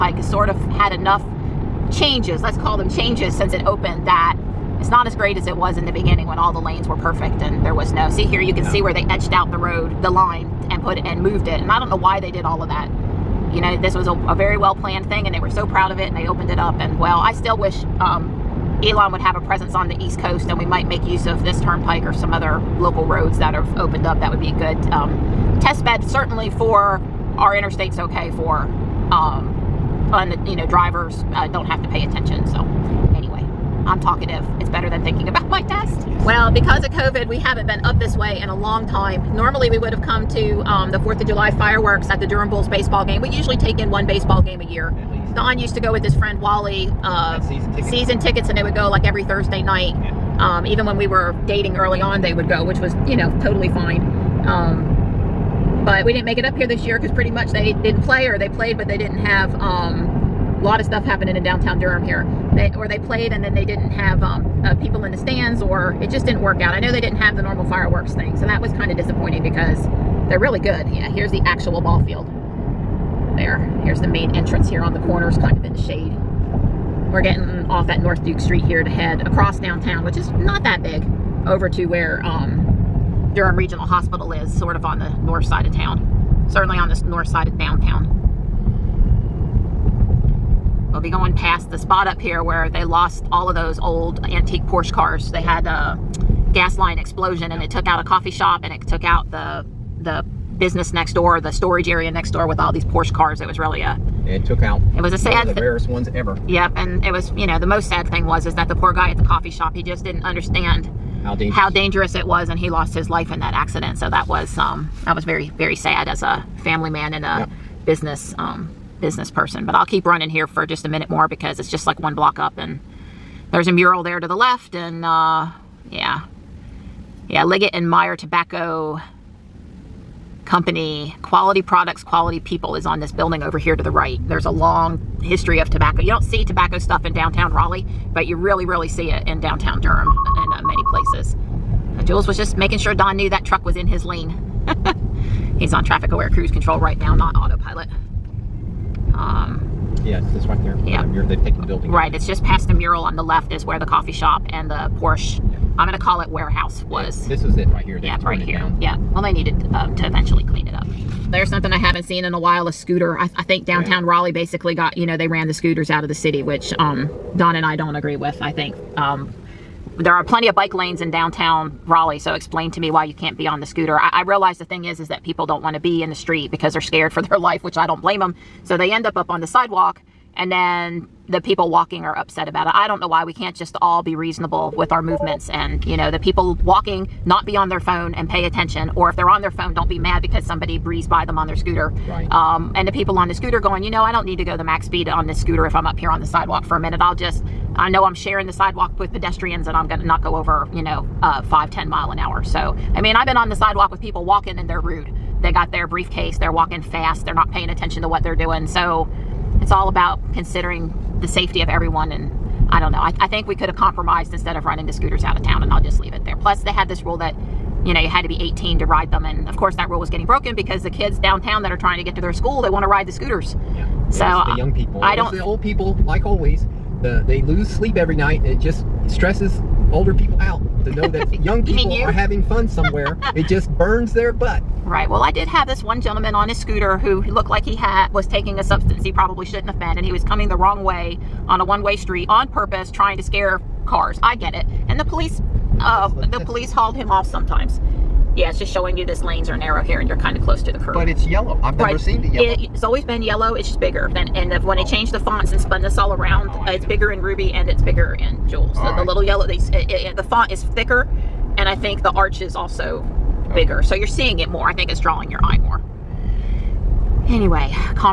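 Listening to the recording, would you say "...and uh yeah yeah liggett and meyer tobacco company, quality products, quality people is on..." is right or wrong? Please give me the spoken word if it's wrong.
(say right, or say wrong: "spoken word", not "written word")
right.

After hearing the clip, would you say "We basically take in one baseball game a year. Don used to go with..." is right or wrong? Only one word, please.
wrong.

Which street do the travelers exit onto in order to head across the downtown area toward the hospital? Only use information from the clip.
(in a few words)
North Duke Street.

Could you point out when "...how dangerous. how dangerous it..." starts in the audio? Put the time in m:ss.
1:51.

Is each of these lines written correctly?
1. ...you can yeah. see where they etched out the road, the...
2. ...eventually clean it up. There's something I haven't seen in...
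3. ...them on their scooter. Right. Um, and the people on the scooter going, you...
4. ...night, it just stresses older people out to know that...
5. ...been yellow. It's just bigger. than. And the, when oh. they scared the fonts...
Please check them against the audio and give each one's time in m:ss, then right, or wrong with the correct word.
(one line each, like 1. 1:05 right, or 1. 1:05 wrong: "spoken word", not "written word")
1. 0:08 right
2. 2:40 right
3. 3:11 right
4. 3:48 right
5. 4:13 wrong: "changed", not "scared".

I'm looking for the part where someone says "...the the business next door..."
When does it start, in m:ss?
1:39.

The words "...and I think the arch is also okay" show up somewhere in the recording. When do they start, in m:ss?
4:21.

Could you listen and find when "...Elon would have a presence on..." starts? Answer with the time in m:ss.
0:18.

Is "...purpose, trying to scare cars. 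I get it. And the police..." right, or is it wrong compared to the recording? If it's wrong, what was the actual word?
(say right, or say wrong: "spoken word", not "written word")
right.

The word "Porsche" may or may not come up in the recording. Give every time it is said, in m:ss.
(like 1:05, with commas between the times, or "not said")
1:34, 1:42, 2:34.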